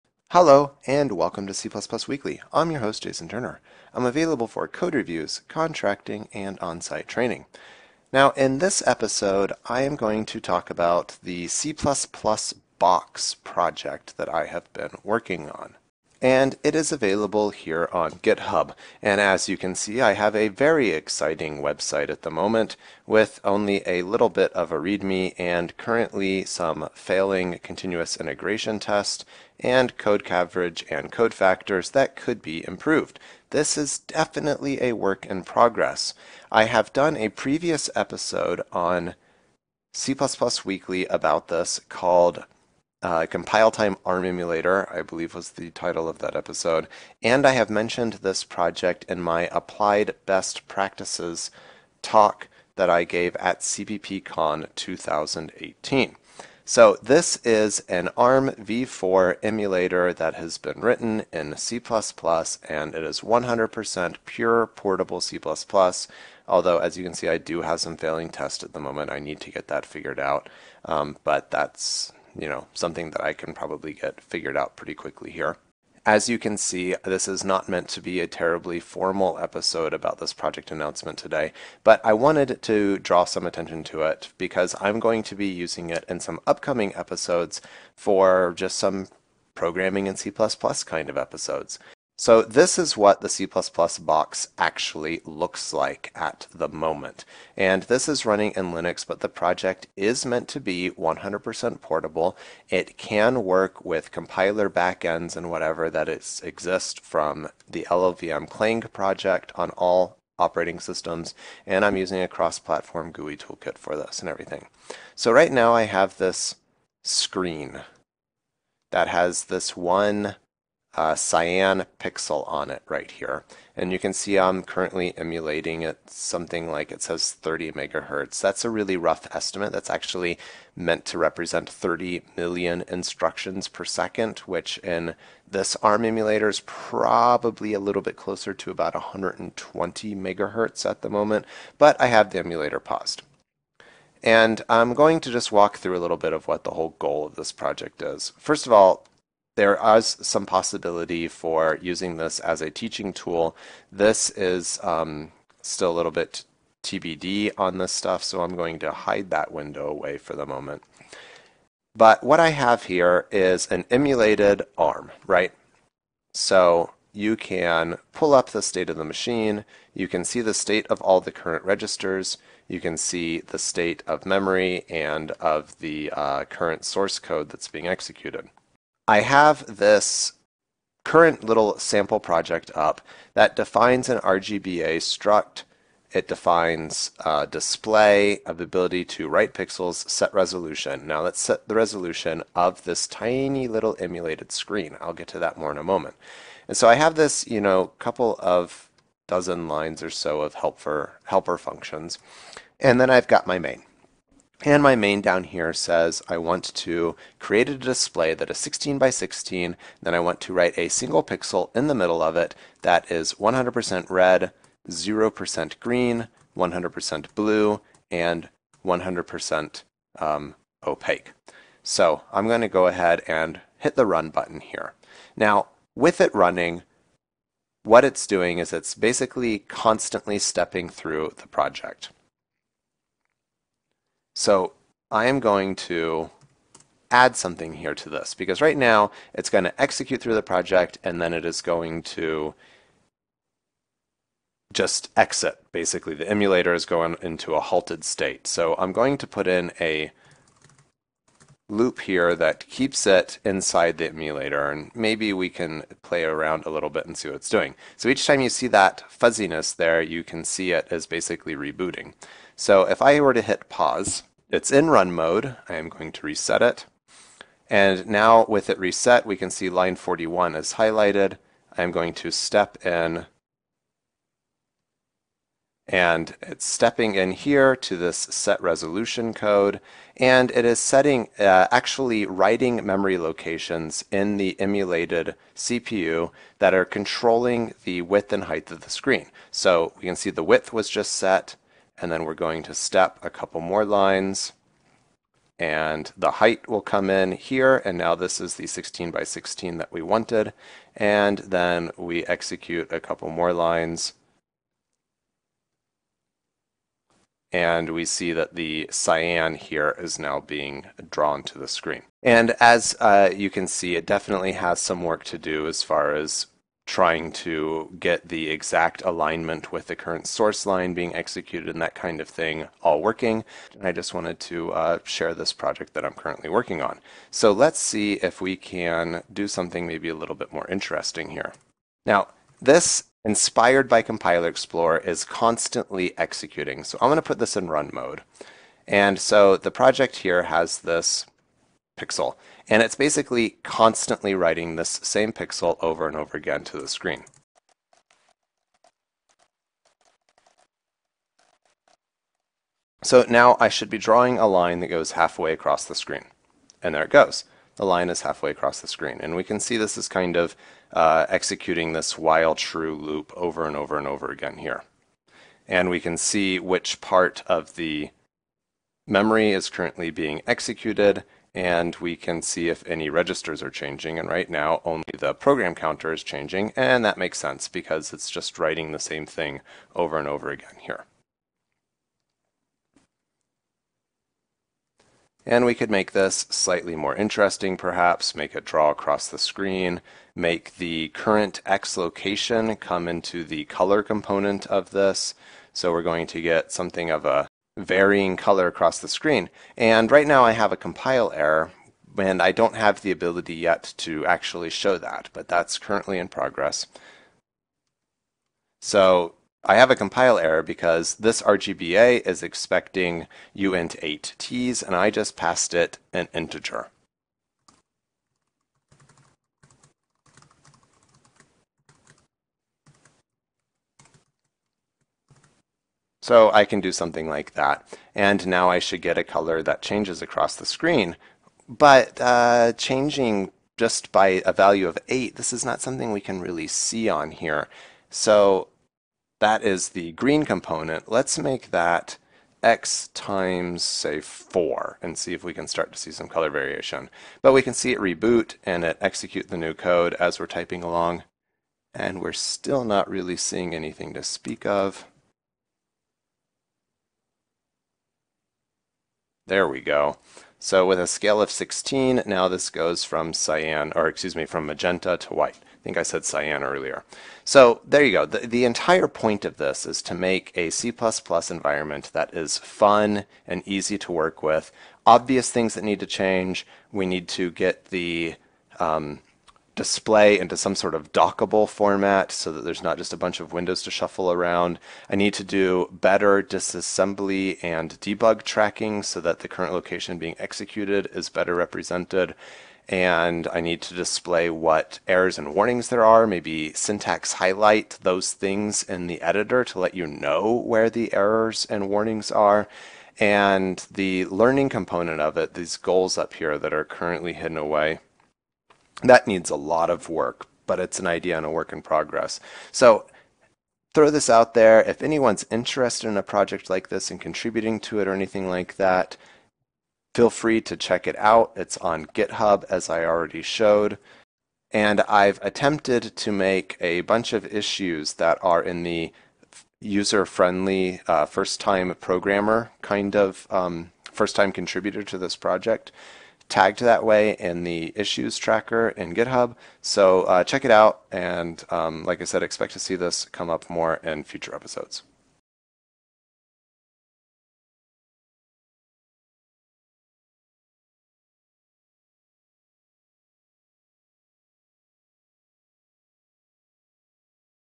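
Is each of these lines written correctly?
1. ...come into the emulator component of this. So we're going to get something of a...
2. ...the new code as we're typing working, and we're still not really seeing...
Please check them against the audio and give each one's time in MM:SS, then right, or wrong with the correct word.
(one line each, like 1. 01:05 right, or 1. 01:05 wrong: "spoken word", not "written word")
1. 06:32 wrong: "color", not "emulator"
2. 07:29 wrong: "along", not "working".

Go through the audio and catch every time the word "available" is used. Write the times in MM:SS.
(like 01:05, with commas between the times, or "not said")
00:04, 00:16.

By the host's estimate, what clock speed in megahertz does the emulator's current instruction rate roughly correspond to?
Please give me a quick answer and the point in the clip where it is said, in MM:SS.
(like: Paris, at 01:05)
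120, at 02:18.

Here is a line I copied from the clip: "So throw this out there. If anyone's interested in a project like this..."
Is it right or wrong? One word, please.
right.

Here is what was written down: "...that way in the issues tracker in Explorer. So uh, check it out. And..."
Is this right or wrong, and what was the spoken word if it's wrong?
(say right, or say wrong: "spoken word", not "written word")
wrong: "GitHub", not "Explorer".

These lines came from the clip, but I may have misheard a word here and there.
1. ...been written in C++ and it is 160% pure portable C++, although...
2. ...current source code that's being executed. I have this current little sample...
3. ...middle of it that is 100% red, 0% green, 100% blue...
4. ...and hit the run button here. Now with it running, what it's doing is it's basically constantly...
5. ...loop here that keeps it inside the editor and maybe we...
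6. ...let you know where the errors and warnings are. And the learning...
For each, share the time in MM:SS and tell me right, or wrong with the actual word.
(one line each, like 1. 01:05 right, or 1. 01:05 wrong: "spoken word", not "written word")
1. 01:00 wrong: "100", not "160"
2. 02:56 right
3. 03:31 right
4. 03:43 right
5. 04:11 wrong: "emulator", not "editor"
6. 08:19 right.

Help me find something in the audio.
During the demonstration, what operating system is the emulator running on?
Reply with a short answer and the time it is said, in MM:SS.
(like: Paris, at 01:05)
Linux, at 01:38.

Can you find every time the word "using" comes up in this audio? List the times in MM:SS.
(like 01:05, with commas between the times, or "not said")
01:25, 01:51, 02:31.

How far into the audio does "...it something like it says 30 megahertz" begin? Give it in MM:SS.
02:05.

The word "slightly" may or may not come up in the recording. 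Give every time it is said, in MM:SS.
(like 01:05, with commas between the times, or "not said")
06:26.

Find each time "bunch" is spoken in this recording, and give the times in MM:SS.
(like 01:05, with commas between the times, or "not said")
08:03, 08:47.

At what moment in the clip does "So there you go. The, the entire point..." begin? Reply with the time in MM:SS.
07:47.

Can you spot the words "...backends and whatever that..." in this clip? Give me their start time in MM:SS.
01:44.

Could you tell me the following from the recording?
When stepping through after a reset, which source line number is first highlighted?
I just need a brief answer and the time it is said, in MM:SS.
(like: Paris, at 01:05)
41, at 04:29.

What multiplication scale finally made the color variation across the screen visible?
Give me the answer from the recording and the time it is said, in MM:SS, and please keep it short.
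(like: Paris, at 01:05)
16, at 07:40.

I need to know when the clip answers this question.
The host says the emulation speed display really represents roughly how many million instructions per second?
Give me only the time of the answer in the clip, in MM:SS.
02:11.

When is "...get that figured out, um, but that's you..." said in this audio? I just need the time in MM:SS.
01:09.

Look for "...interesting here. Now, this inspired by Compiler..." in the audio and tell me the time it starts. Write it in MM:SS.
05:30.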